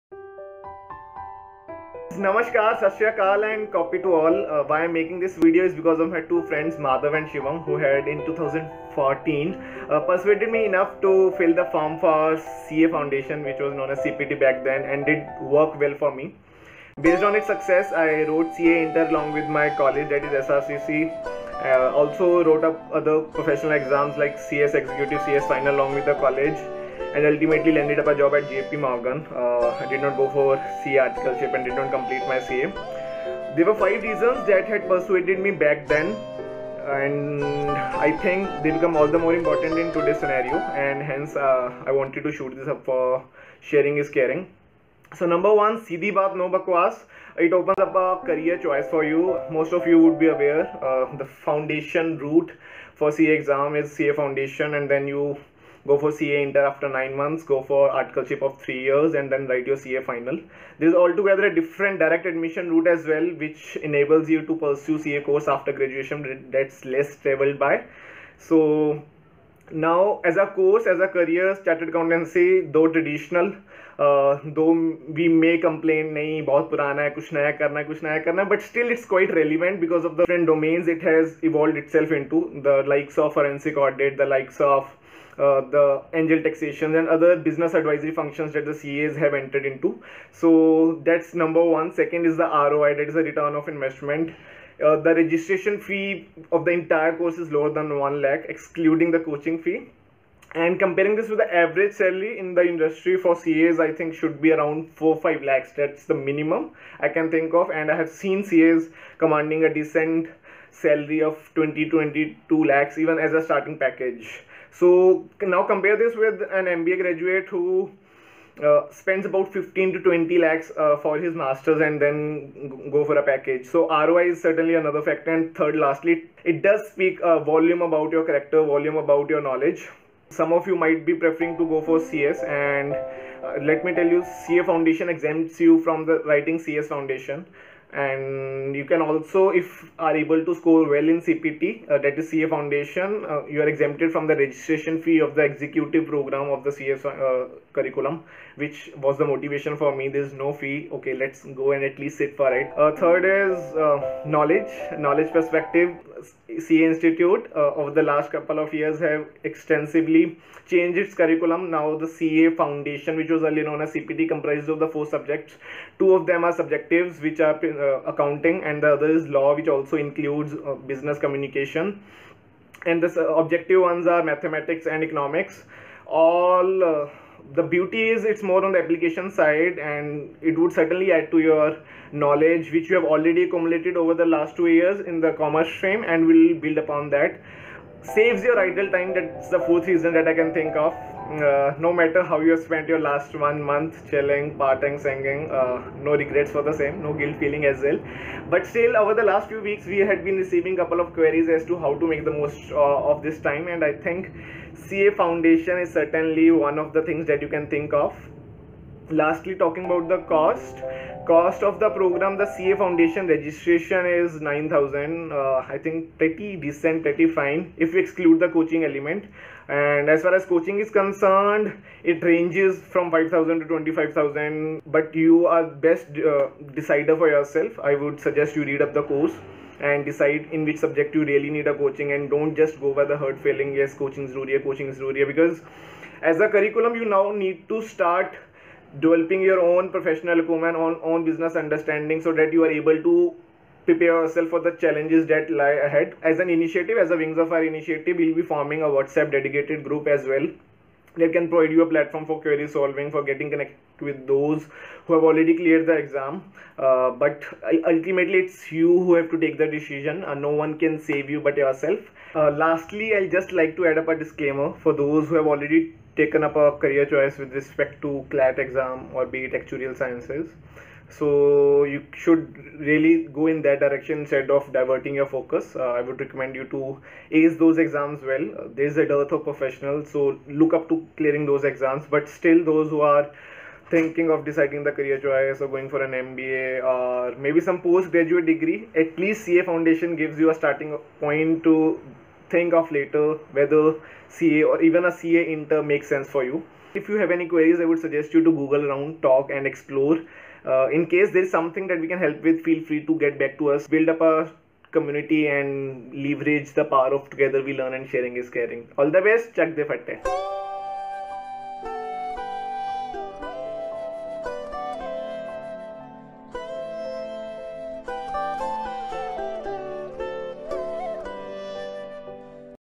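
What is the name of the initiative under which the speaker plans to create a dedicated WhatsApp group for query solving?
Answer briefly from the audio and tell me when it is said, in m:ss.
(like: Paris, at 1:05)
Wings of Fire, at 4:07.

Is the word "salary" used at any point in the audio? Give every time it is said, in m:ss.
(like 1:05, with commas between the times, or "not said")
1:41, 1:50.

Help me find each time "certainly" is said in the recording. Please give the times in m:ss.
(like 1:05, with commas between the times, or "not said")
2:04, 3:00, 3:25.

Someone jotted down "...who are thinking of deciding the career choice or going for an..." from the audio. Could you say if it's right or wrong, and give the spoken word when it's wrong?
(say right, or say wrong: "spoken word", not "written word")
right.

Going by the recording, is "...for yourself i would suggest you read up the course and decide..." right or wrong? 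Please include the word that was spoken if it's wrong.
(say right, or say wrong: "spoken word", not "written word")
right.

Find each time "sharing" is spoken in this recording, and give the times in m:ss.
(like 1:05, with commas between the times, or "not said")
0:43, 5:08.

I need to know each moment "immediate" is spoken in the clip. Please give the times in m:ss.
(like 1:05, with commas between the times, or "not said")
not said.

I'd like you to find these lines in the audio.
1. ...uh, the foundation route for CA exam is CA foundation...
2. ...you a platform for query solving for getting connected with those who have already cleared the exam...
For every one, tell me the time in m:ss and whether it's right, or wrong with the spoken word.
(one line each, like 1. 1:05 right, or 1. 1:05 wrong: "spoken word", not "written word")
1. 0:50 right
2. 4:11 right.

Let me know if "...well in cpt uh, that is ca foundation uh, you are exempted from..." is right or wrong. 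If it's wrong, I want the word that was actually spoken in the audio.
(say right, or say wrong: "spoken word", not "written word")
right.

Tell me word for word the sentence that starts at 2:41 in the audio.
Now the CA Foundation, which was earlier known as CPT, comprises of the four subjects.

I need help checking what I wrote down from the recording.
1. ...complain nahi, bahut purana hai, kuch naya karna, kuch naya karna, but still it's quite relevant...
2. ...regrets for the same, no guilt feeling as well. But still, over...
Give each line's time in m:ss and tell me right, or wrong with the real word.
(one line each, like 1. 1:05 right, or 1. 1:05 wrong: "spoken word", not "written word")
1. 1:15 right
2. 3:16 right.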